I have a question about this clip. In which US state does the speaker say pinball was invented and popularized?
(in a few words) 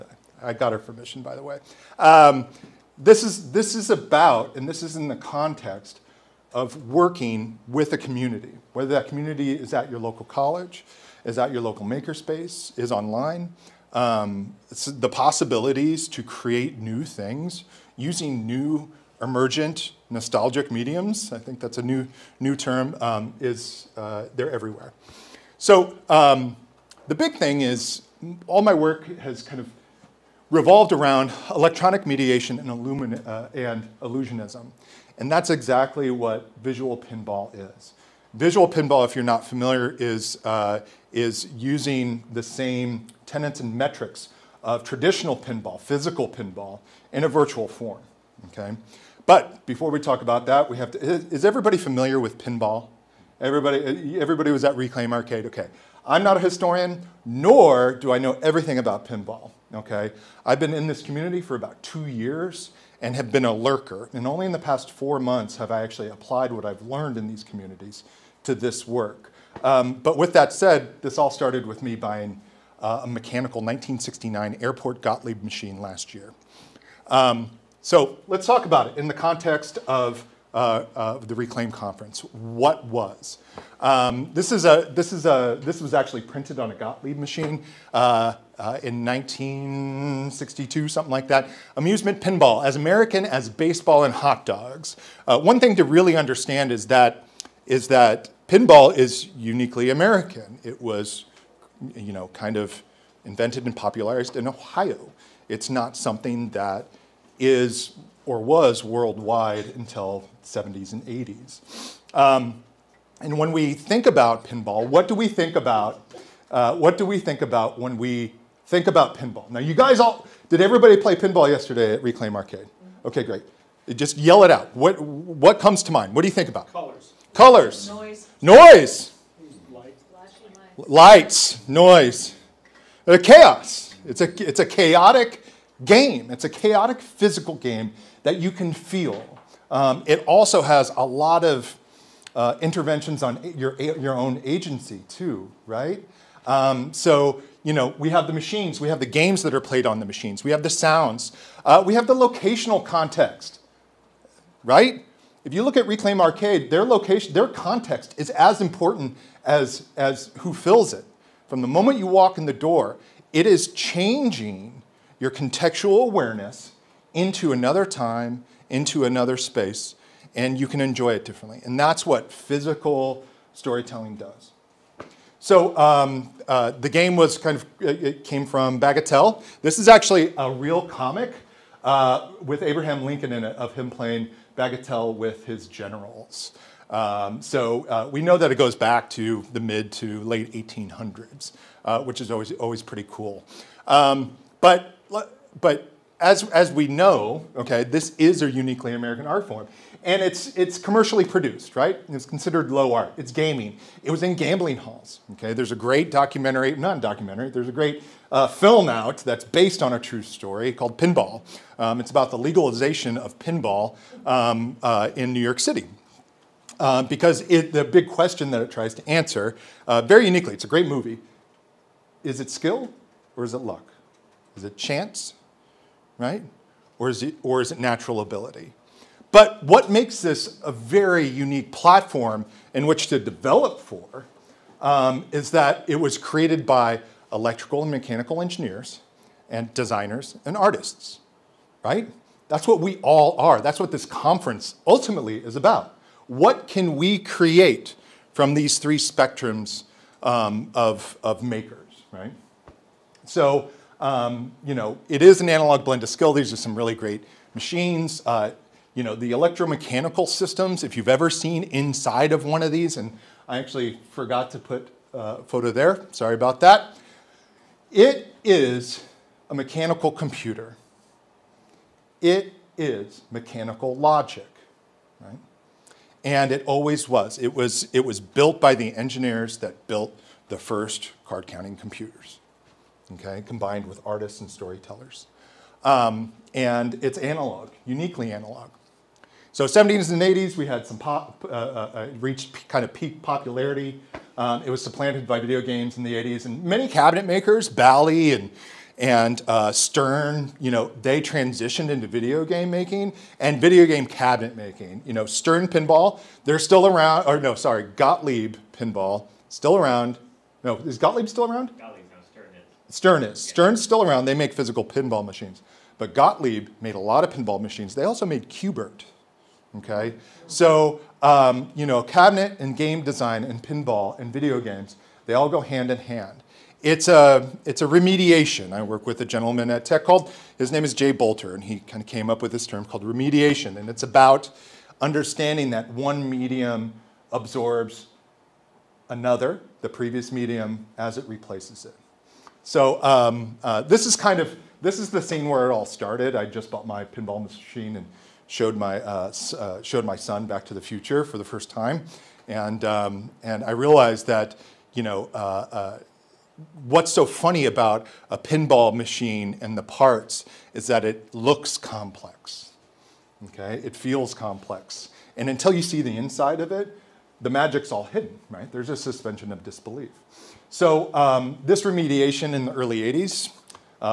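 Ohio.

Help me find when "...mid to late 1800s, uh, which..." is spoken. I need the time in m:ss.
3:09.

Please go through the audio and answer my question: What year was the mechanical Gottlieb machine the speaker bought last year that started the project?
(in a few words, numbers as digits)
1969.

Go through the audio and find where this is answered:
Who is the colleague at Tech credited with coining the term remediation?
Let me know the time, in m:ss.
5:30.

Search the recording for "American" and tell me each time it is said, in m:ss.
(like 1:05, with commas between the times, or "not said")
1:32, 1:39, 3:18.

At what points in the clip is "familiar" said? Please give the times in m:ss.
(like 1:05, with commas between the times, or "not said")
0:39, 0:51.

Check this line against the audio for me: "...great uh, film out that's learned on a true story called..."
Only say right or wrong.
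wrong.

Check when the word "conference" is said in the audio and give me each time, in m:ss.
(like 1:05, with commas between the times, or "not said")
1:21, 4:04.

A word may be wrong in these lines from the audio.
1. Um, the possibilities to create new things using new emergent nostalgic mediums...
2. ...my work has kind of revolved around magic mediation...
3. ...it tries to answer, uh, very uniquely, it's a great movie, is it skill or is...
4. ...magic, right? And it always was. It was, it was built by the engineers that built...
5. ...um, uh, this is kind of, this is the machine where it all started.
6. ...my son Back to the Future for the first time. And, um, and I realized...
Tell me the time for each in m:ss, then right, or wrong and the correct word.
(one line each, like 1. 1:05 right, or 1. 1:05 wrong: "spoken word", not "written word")
1. 0:13 right
2. 0:28 wrong: "electronic", not "magic"
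3. 3:38 right
4. 4:33 wrong: "logic", not "magic"
5. 5:43 wrong: "scene", not "machine"
6. 5:50 right.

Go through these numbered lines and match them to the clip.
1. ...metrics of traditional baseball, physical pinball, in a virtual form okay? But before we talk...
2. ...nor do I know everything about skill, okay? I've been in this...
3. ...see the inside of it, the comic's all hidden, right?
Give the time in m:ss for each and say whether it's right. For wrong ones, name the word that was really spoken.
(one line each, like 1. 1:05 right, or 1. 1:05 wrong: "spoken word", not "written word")
1. 0:43 wrong: "pinball", not "baseball"
2. 0:57 wrong: "pinball", not "skill"
3. 6:05 wrong: "magic", not "comic".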